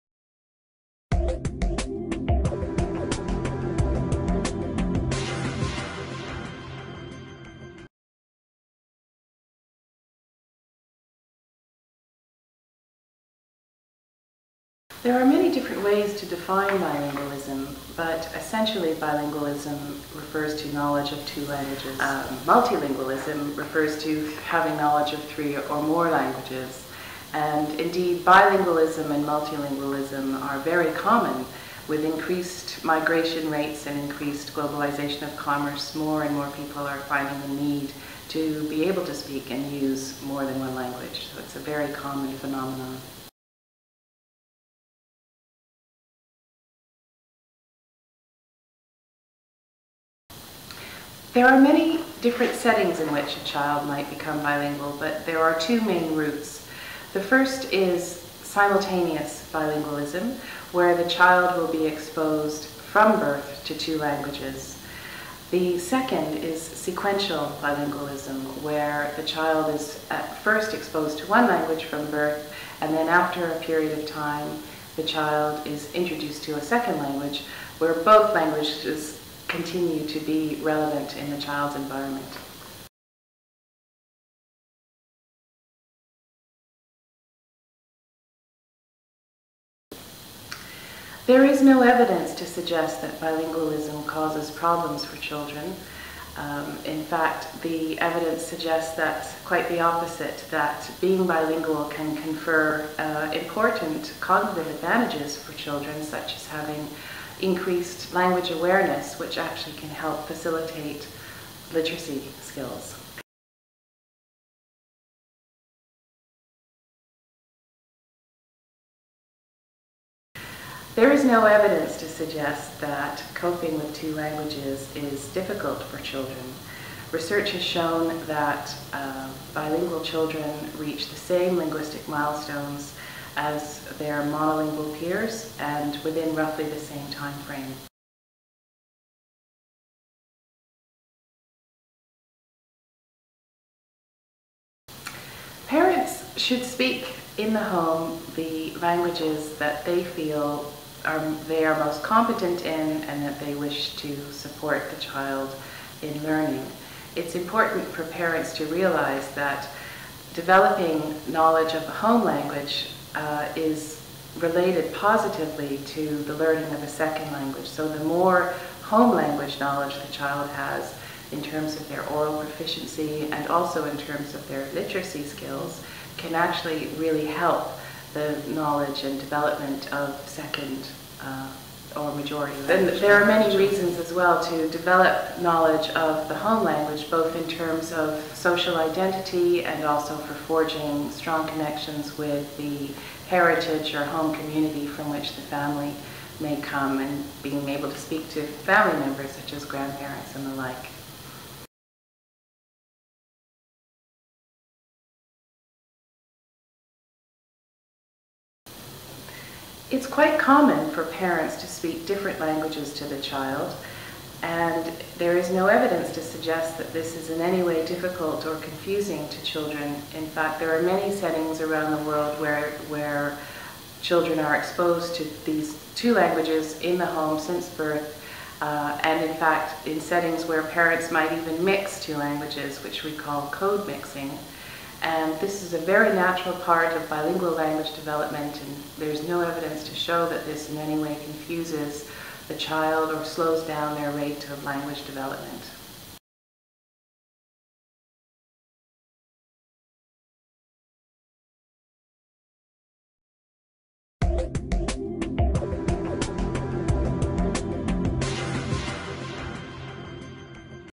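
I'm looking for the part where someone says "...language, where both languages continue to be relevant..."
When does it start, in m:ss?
1:16.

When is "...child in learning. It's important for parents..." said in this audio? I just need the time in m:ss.
2:35.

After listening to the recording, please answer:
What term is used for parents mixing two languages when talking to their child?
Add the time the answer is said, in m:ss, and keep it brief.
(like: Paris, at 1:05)
code mixing, at 3:53.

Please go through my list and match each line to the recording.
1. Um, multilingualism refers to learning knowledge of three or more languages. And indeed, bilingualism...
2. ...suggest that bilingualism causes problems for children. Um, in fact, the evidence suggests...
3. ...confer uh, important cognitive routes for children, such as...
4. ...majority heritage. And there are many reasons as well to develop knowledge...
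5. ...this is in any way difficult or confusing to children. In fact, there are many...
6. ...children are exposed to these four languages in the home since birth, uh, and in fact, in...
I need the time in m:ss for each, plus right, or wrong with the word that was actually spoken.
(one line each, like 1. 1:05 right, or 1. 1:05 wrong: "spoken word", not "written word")
1. 0:21 wrong: "having", not "learning"
2. 1:32 right
3. 1:42 wrong: "advantages", not "routes"
4. 3:02 wrong: "language", not "heritage"
5. 3:36 right
6. 3:44 wrong: "two", not "four".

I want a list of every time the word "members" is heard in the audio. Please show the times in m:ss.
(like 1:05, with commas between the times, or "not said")
3:18.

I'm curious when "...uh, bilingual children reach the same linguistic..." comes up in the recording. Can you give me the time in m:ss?
2:08.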